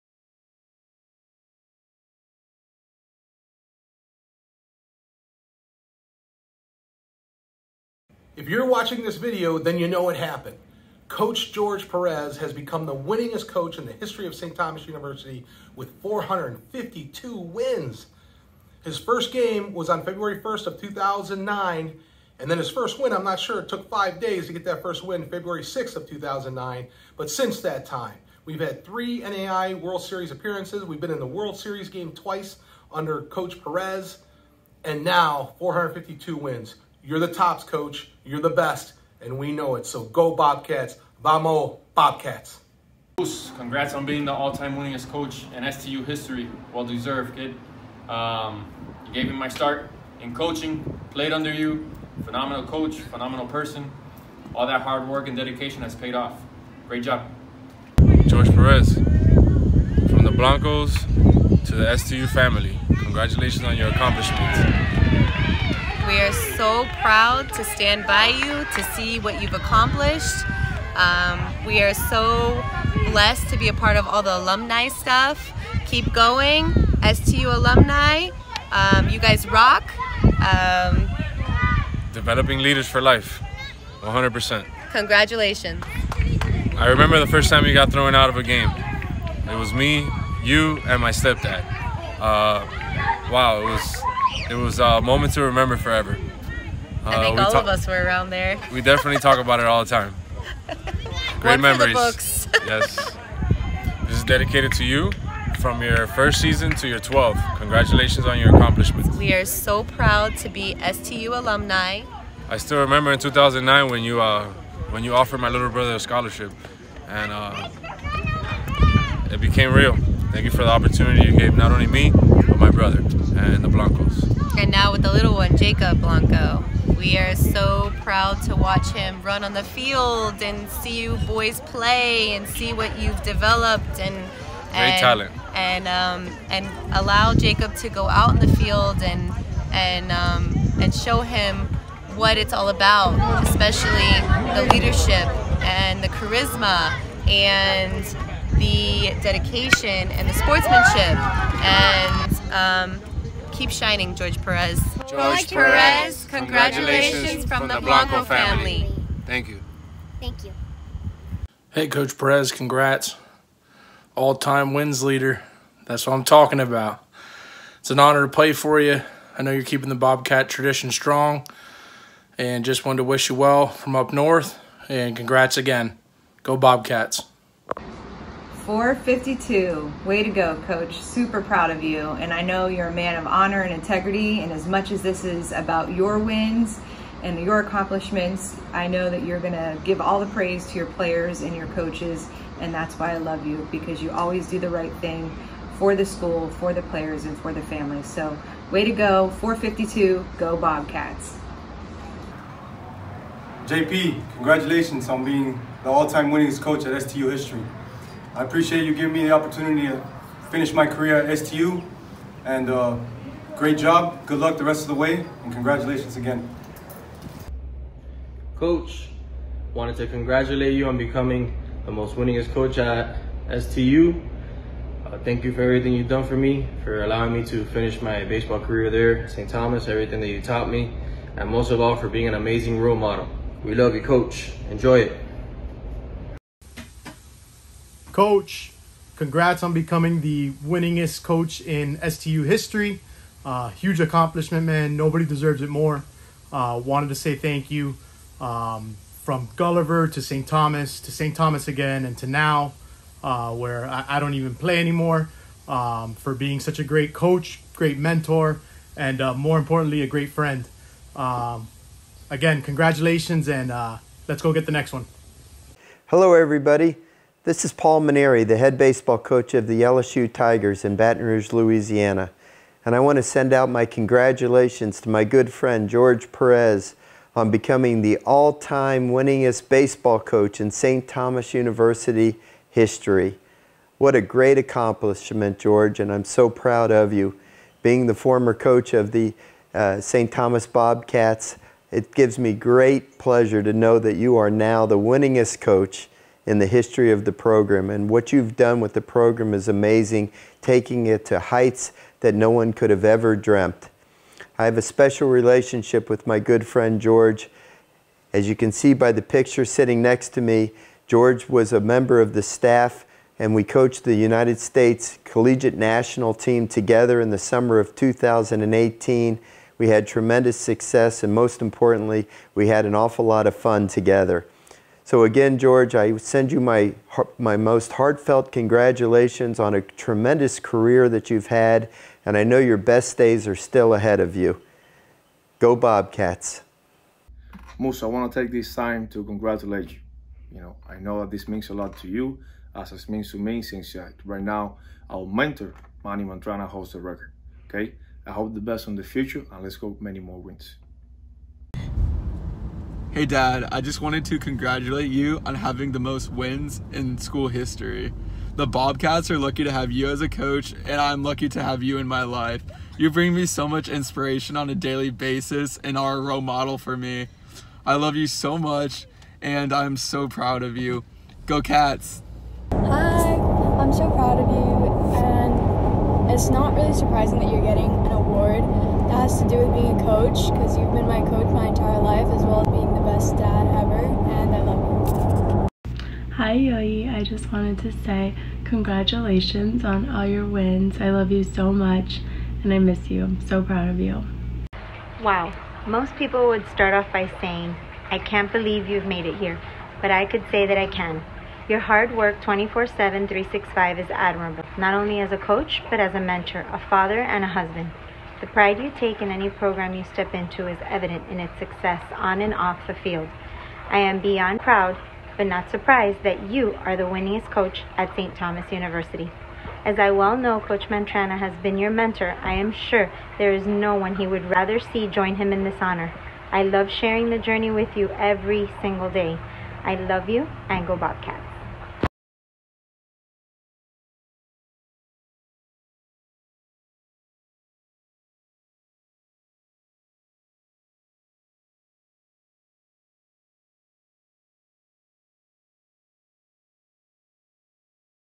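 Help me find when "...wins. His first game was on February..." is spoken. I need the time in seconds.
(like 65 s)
17 s.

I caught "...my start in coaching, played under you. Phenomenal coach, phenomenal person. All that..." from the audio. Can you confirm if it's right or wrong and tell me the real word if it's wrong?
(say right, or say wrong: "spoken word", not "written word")
right.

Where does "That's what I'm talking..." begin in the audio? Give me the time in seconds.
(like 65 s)
165 s.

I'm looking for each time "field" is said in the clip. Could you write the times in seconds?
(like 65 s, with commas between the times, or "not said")
129 s, 138 s, 412 s.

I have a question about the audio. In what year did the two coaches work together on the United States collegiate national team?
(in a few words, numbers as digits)
2018.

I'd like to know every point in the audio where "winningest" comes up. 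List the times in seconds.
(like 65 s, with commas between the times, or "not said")
12 s, 44 s, 206 s, 222 s, 240 s, 279 s, 294 s, 417 s.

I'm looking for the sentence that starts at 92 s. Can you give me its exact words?
Uh, wow, it was it was a moment to remember forever.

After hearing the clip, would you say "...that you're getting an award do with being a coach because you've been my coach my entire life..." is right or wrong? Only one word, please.
right.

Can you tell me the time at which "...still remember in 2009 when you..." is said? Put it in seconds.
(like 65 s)
112 s.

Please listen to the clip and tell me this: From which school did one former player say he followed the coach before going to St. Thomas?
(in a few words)
Gulliver.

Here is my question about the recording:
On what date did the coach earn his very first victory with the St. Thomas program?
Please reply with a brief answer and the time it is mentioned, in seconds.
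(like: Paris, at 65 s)
February 6th of 2009, at 25 s.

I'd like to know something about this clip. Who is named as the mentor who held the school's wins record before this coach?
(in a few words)
Manny Mantrana.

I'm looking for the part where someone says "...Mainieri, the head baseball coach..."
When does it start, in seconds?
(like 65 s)
268 s.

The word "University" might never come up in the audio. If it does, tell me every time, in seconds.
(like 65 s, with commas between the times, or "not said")
14 s, 281 s, 418 s.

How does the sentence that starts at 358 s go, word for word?
The Bobcats are lucky to have you as a coach, and I'm lucky to have you in my life.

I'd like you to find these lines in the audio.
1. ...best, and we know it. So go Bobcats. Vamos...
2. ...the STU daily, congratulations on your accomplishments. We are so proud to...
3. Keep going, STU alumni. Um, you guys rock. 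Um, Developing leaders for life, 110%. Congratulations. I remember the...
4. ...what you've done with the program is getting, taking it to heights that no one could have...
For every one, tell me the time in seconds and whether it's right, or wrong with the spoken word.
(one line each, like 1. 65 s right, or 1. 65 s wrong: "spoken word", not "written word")
1. 38 s right
2. 61 s wrong: "family", not "daily"
3. 75 s wrong: "100", not "110"
4. 298 s wrong: "amazing", not "getting".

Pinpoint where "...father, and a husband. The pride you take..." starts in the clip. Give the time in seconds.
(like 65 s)
406 s.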